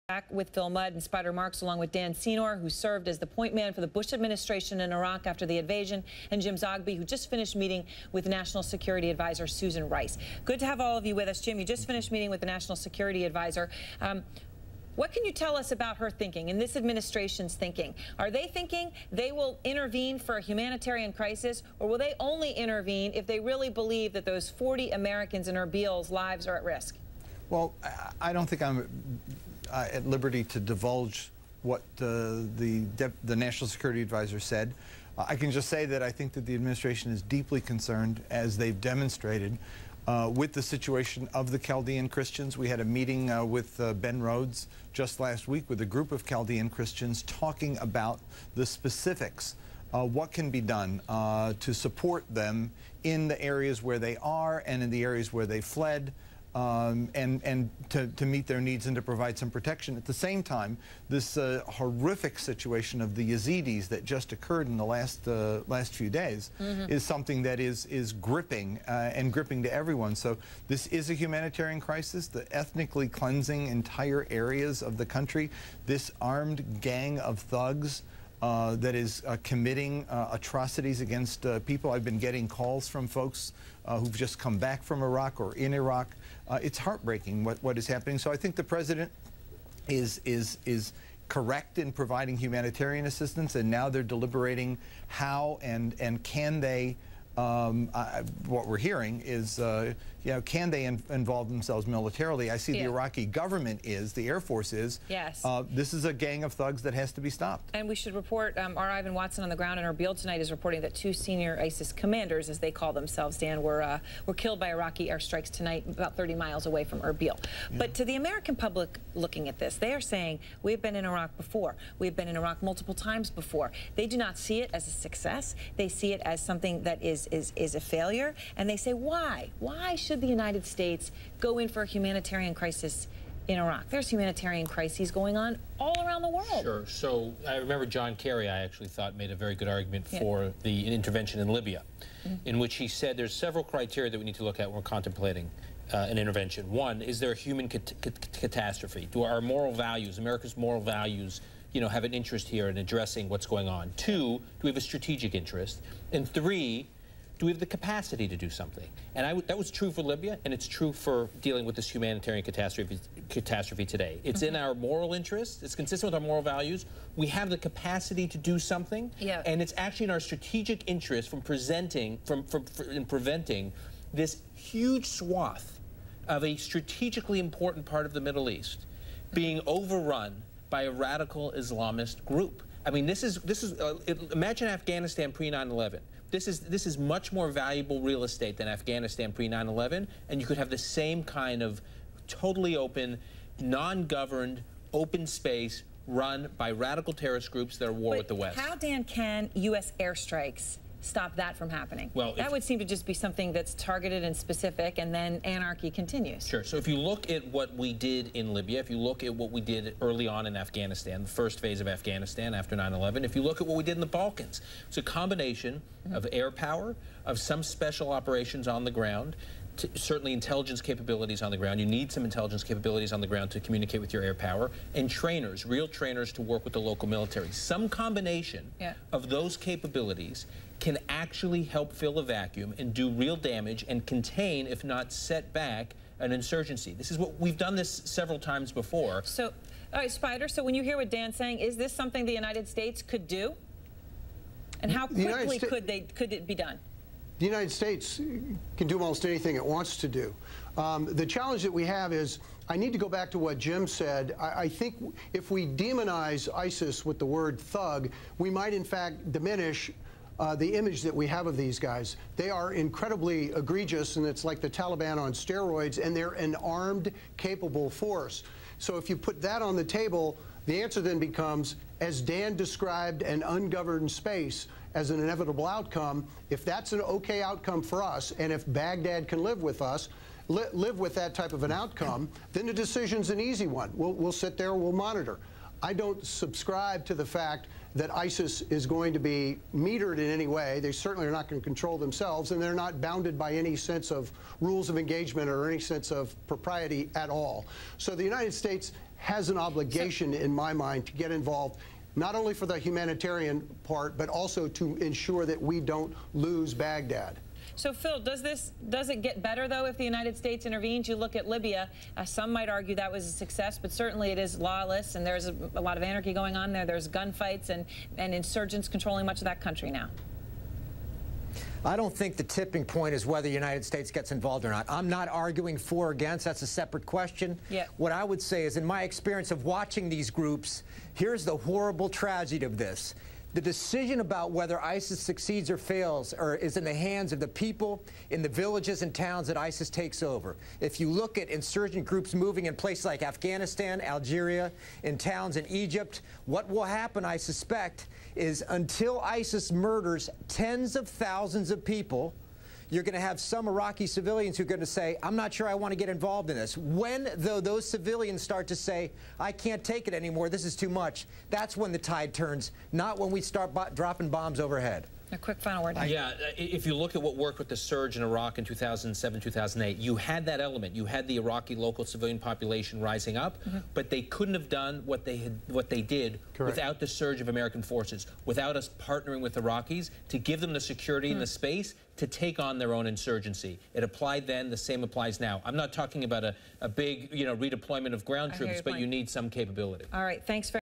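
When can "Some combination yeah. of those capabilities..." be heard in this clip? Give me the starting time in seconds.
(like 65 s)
227 s.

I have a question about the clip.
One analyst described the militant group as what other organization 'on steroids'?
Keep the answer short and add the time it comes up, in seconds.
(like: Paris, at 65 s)
the Taliban, at 264 s.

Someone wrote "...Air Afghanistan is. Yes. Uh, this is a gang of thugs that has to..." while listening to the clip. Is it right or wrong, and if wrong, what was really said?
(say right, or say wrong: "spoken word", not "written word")
wrong: "Force", not "Afghanistan".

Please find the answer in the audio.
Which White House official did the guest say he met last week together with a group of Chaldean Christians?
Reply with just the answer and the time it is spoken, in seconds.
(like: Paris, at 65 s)
Ben Rhodes, at 43 s.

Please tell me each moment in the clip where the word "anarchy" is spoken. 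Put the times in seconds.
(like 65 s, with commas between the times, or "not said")
205 s, 316 s.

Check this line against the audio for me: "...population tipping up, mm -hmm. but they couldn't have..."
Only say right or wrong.
wrong.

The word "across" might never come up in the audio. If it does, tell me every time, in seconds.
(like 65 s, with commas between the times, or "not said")
not said.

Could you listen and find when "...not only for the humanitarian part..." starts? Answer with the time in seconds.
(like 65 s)
302 s.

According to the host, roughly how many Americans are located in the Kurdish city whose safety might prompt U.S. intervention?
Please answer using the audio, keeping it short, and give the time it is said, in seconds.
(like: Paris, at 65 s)
40, at 24 s.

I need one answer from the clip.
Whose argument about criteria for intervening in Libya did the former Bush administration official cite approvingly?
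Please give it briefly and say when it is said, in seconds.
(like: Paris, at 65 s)
John Kerry, at 137 s.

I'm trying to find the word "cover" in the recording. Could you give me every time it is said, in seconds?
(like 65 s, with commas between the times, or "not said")
not said.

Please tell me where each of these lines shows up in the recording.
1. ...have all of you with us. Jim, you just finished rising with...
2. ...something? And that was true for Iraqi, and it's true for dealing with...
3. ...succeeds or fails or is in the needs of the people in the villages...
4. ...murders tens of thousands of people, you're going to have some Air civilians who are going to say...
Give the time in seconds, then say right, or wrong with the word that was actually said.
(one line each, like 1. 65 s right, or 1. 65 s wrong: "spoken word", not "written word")
1. 10 s wrong: "meeting", not "rising"
2. 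158 s wrong: "Libya", not "Iraqi"
3. 335 s wrong: "hands", not "needs"
4. 349 s wrong: "Iraqi", not "Air".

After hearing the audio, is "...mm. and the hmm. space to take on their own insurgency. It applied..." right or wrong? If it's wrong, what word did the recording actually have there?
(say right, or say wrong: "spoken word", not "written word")
right.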